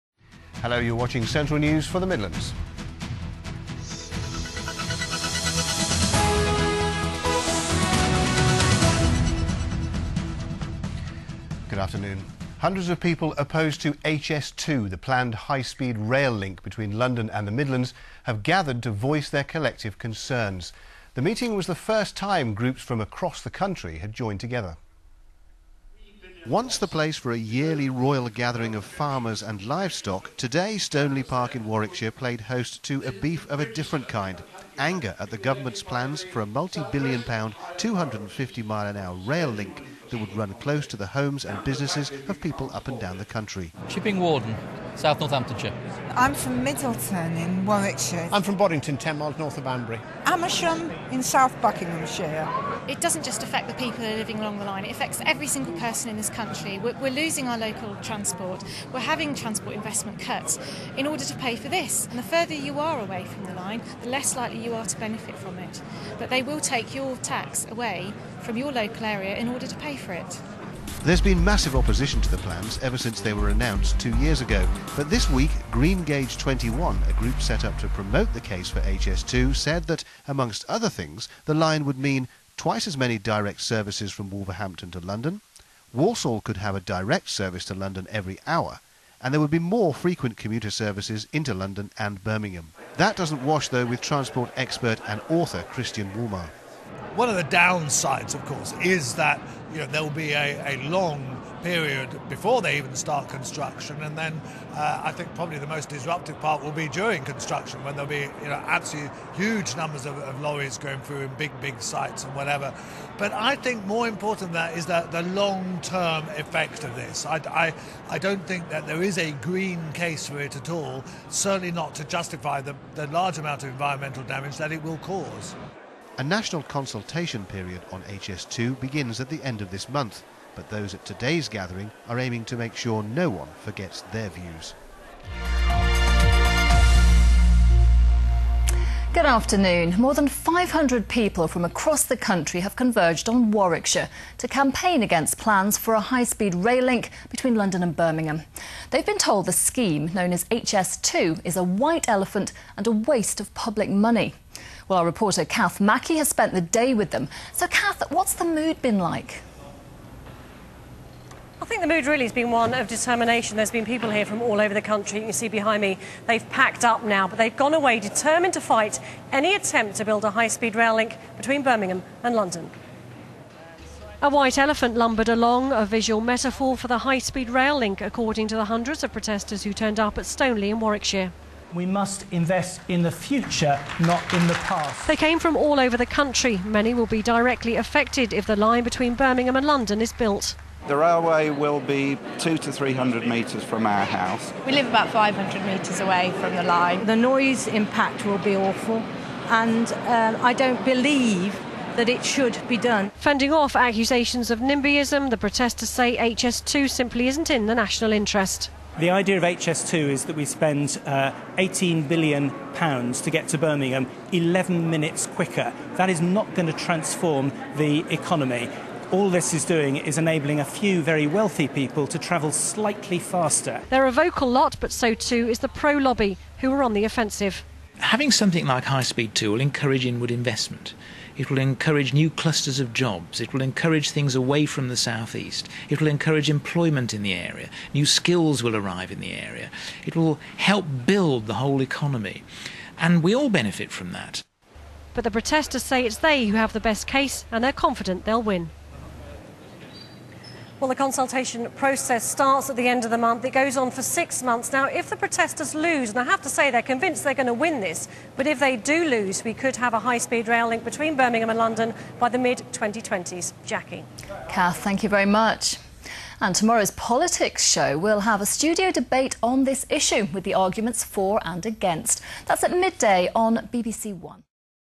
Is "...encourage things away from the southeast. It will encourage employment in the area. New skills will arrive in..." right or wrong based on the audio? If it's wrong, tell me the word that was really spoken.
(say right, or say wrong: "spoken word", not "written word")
right.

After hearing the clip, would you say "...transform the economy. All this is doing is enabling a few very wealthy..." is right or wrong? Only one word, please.
right.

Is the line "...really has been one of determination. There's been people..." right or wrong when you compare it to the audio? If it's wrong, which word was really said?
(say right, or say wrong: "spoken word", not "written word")
right.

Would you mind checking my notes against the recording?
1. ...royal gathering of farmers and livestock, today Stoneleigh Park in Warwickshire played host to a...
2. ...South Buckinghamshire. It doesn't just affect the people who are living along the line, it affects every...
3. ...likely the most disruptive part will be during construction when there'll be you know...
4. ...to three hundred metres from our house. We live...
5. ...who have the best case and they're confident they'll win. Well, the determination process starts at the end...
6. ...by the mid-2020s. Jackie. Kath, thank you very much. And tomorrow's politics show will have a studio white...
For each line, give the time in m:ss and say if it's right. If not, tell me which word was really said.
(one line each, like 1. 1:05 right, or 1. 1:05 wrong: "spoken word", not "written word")
1. 0:27 right
2. 0:51 right
3. 1:45 wrong: "probably", not "likely"
4. 3:12 right
5. 4:06 wrong: "consultation", not "determination"
6. 4:22 wrong: "debate", not "white".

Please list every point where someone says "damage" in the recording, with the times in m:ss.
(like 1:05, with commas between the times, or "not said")
2:04.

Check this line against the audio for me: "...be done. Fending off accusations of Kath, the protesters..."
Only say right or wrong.
wrong.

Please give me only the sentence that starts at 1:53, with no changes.
But I think more important than that is that the long term effect of this.